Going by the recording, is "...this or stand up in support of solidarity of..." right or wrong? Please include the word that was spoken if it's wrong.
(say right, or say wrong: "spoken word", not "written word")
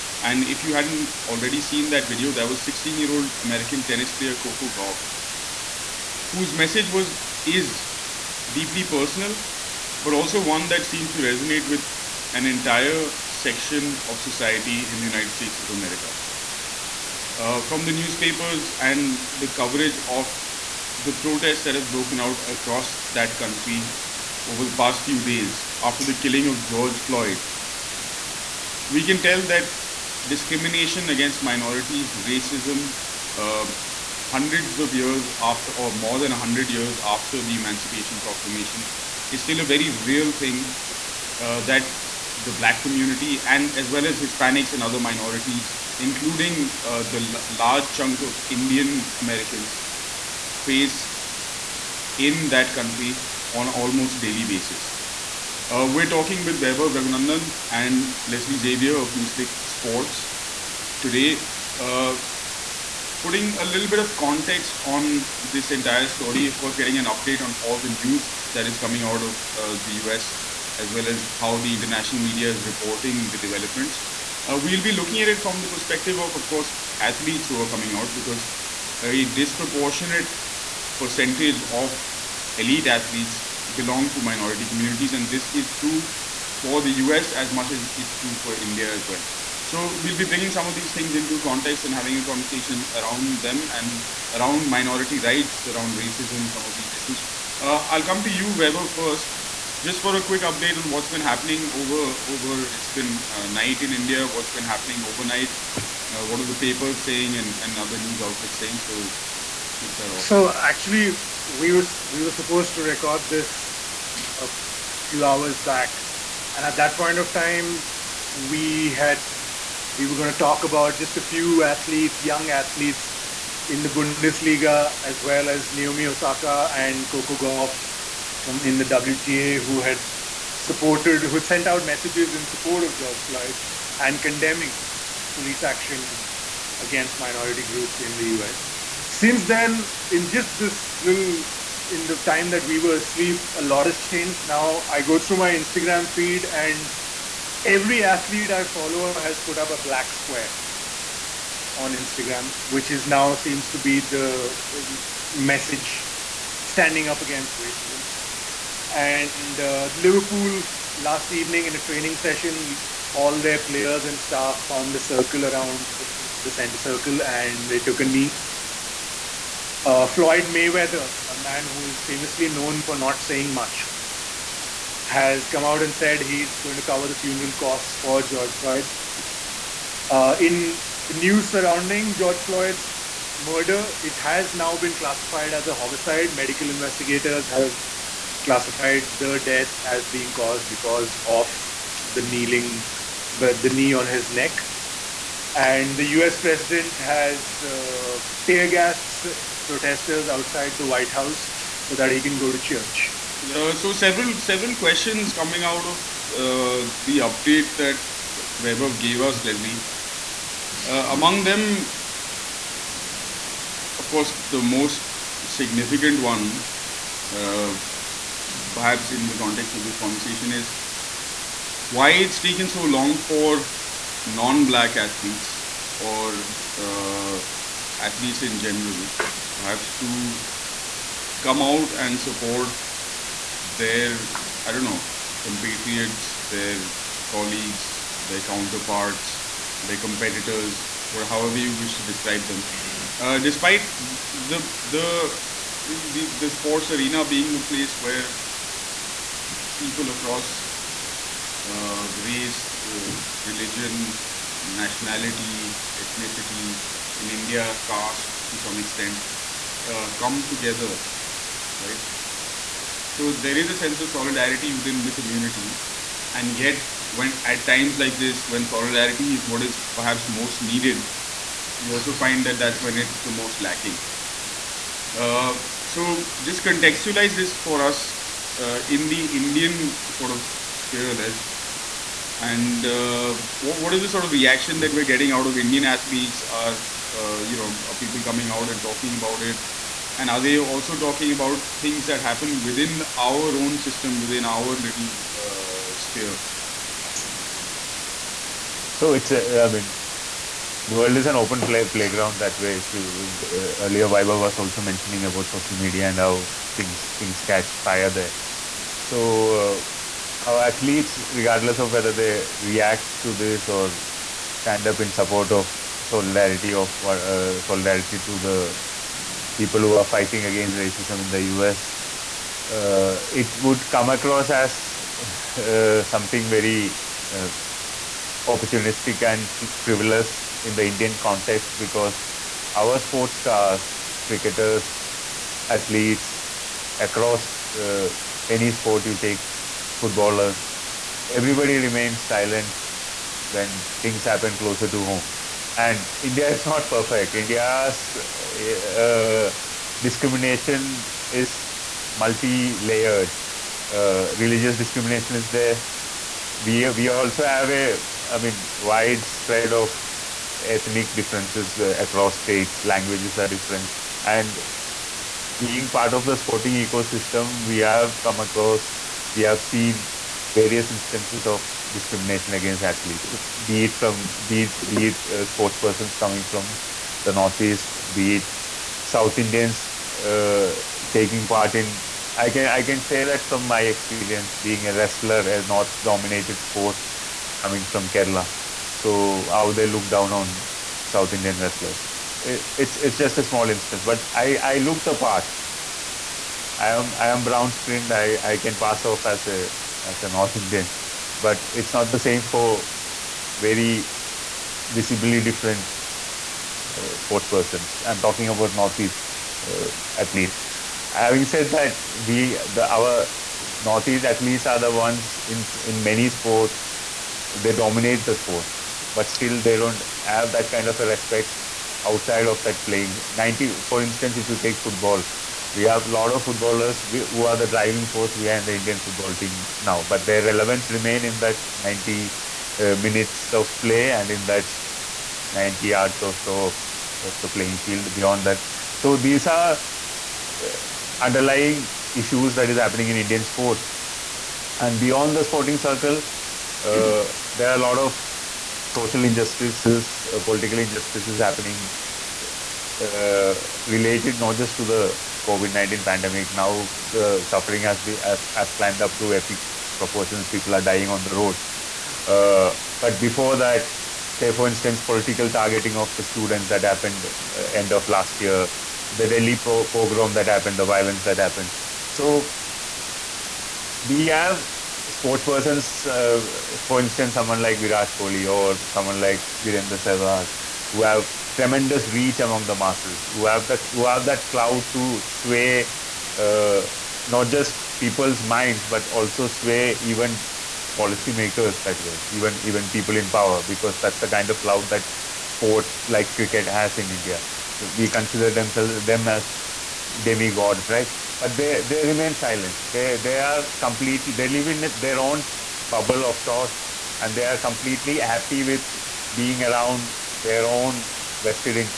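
right.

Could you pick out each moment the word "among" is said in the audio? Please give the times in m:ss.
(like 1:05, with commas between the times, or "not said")
3:31, 8:02.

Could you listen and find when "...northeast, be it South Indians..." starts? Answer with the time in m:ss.
6:17.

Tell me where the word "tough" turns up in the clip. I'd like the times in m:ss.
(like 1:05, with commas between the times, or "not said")
not said.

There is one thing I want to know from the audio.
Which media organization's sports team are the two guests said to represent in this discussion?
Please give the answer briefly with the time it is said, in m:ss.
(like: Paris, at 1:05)
NewsClick Sports, at 0:59.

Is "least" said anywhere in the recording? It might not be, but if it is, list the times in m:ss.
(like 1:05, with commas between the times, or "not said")
6:50, 6:54.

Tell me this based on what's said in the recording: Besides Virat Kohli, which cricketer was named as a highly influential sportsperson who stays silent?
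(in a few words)
Virender Sehwag.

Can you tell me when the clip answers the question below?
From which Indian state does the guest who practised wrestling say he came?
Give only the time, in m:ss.
6:28.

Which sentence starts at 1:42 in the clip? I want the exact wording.
It's been uh, night in India.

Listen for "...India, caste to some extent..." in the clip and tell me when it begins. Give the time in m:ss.
4:17.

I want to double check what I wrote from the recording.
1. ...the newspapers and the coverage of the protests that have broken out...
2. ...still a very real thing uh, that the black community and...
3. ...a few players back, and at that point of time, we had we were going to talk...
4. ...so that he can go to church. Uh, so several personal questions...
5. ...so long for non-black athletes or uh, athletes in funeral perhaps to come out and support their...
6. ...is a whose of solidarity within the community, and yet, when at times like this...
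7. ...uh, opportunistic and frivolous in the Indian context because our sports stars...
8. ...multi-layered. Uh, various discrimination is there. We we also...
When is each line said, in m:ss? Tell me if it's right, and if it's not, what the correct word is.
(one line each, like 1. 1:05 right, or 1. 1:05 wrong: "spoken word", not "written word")
1. 0:17 right
2. 0:39 right
3. 1:54 wrong: "hours", not "players"
4. 3:21 wrong: "several", not "personal"
5. 3:42 wrong: "general", not "funeral"
6. 4:23 wrong: "sense", not "whose"
7. 5:27 right
8. 5:52 wrong: "religious", not "various".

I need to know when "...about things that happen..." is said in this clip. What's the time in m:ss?
4:51.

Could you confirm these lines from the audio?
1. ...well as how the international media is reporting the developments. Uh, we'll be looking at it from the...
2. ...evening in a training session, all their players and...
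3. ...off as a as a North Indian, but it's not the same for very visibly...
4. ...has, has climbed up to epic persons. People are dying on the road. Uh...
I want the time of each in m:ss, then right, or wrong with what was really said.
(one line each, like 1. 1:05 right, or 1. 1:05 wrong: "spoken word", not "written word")
1. 1:10 right
2. 2:41 right
3. 6:39 right
4. 7:38 wrong: "proportions", not "persons".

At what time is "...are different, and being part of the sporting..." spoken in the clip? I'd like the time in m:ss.
6:03.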